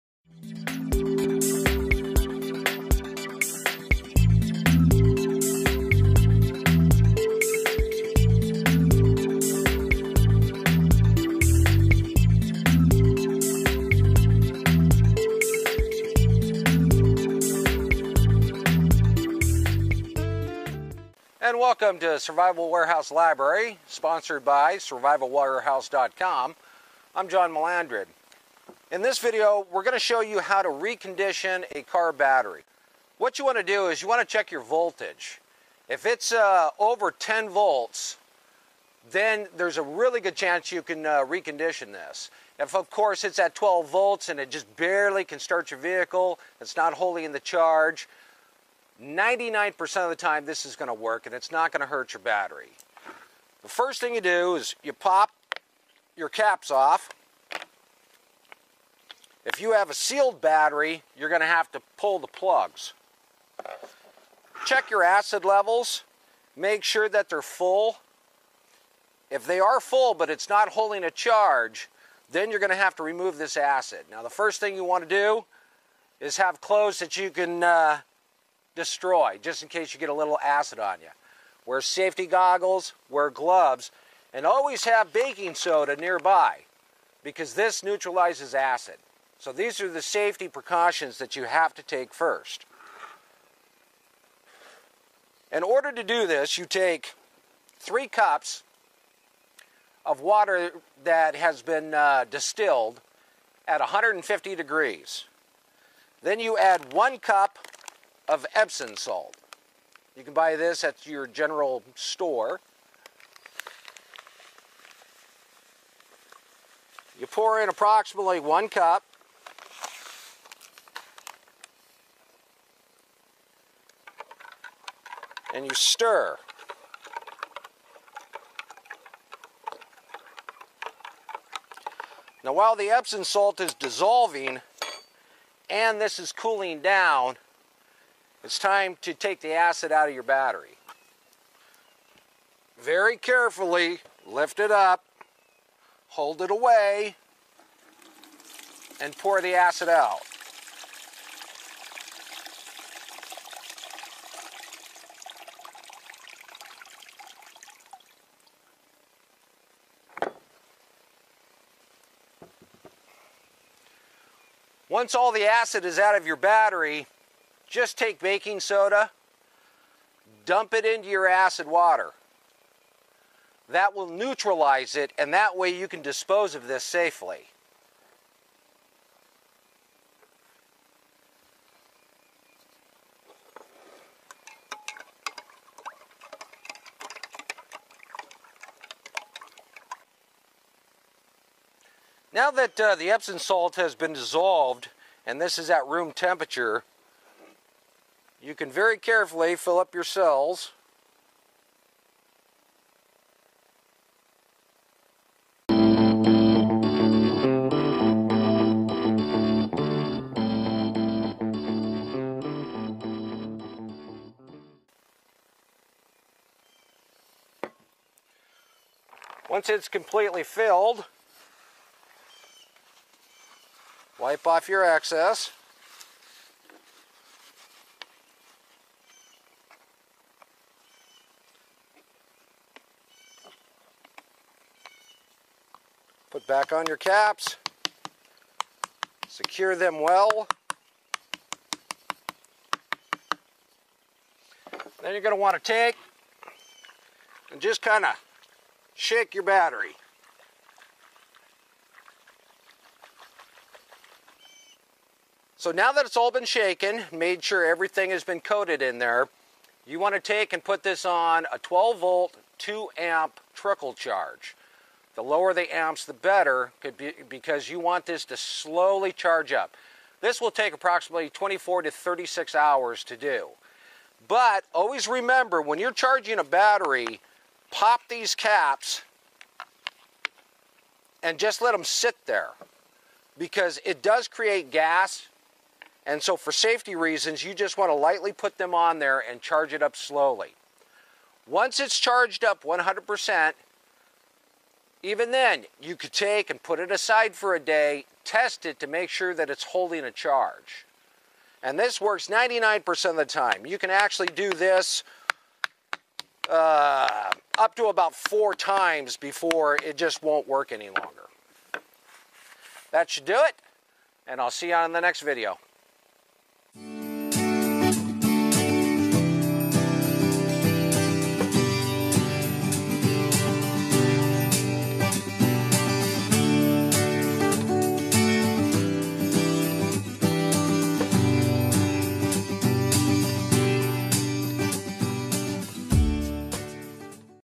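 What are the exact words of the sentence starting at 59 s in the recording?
If you have a sealed battery, you're going to have to pull the plugs.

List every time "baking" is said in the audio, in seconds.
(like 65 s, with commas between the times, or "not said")
85 s, 168 s.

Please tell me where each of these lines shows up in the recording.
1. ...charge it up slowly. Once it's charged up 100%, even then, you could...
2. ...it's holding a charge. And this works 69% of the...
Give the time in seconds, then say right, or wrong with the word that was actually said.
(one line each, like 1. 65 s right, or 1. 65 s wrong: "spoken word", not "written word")
1. 289 s right
2. 299 s wrong: "99", not "69".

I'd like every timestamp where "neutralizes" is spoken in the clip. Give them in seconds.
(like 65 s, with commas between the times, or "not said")
87 s, 174 s.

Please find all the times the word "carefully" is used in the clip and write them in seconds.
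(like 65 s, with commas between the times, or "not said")
143 s, 198 s.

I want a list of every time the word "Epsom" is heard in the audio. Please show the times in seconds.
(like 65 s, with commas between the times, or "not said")
108 s, 132 s, 193 s.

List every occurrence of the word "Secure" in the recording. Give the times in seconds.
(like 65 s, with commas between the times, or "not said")
239 s.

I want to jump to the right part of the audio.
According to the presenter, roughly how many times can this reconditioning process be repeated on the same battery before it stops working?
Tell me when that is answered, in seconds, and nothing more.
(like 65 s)
308 s.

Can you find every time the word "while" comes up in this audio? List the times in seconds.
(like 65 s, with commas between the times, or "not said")
132 s.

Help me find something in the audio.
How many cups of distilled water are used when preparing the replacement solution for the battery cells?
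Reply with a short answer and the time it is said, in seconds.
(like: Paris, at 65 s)
3 cups, at 97 s.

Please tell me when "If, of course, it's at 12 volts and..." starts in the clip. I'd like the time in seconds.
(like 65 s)
42 s.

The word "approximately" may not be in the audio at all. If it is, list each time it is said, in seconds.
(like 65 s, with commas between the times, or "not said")
117 s, 270 s.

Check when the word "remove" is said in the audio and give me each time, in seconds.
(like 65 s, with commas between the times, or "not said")
73 s.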